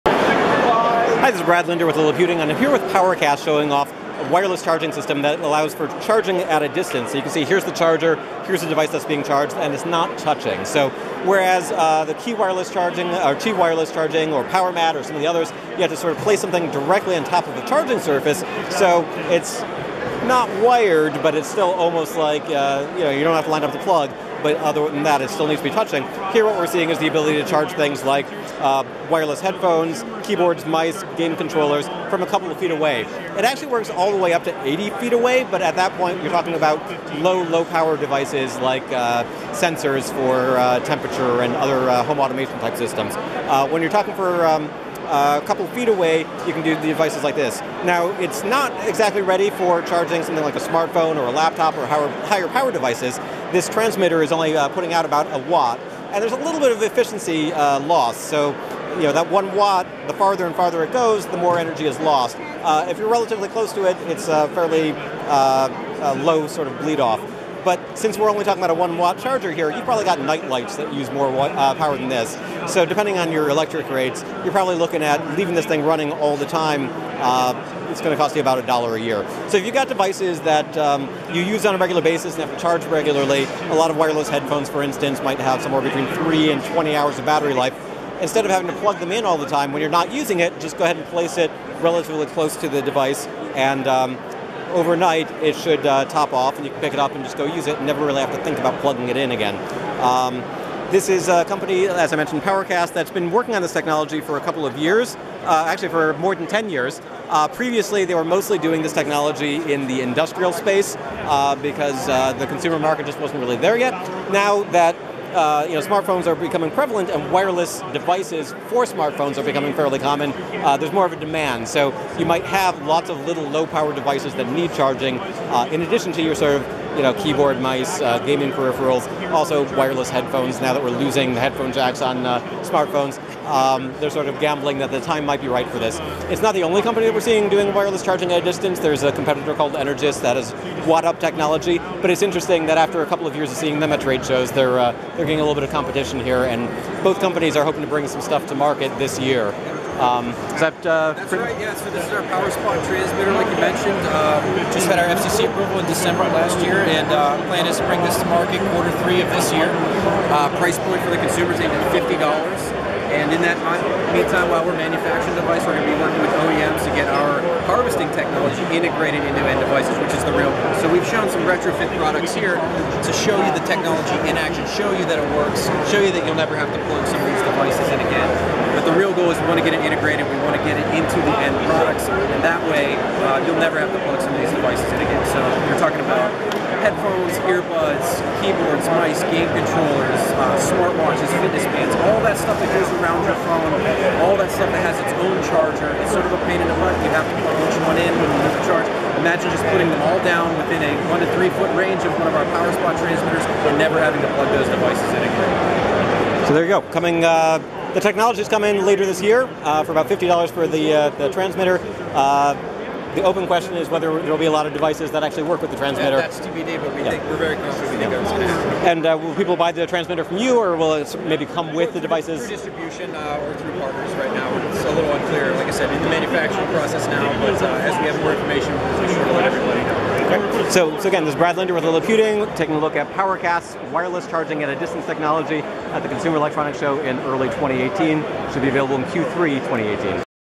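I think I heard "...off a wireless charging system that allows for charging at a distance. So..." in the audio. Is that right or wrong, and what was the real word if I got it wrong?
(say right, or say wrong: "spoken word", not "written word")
right.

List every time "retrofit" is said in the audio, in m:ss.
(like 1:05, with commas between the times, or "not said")
2:51.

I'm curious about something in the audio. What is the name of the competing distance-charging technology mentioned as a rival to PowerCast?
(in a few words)
WattUp.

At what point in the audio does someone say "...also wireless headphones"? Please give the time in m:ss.
2:09.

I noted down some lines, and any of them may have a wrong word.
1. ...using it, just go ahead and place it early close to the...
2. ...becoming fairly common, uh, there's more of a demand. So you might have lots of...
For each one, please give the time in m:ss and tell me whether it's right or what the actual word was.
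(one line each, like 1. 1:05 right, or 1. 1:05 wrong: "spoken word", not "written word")
1. 1:30 wrong: "relatively", not "early"
2. 1:59 right.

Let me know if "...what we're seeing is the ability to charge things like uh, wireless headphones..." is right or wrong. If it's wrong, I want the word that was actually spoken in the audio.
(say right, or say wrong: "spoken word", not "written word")
right.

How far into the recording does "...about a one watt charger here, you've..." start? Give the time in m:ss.
1:08.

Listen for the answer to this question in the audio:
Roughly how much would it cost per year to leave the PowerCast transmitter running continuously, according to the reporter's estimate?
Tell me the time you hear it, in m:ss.
1:18.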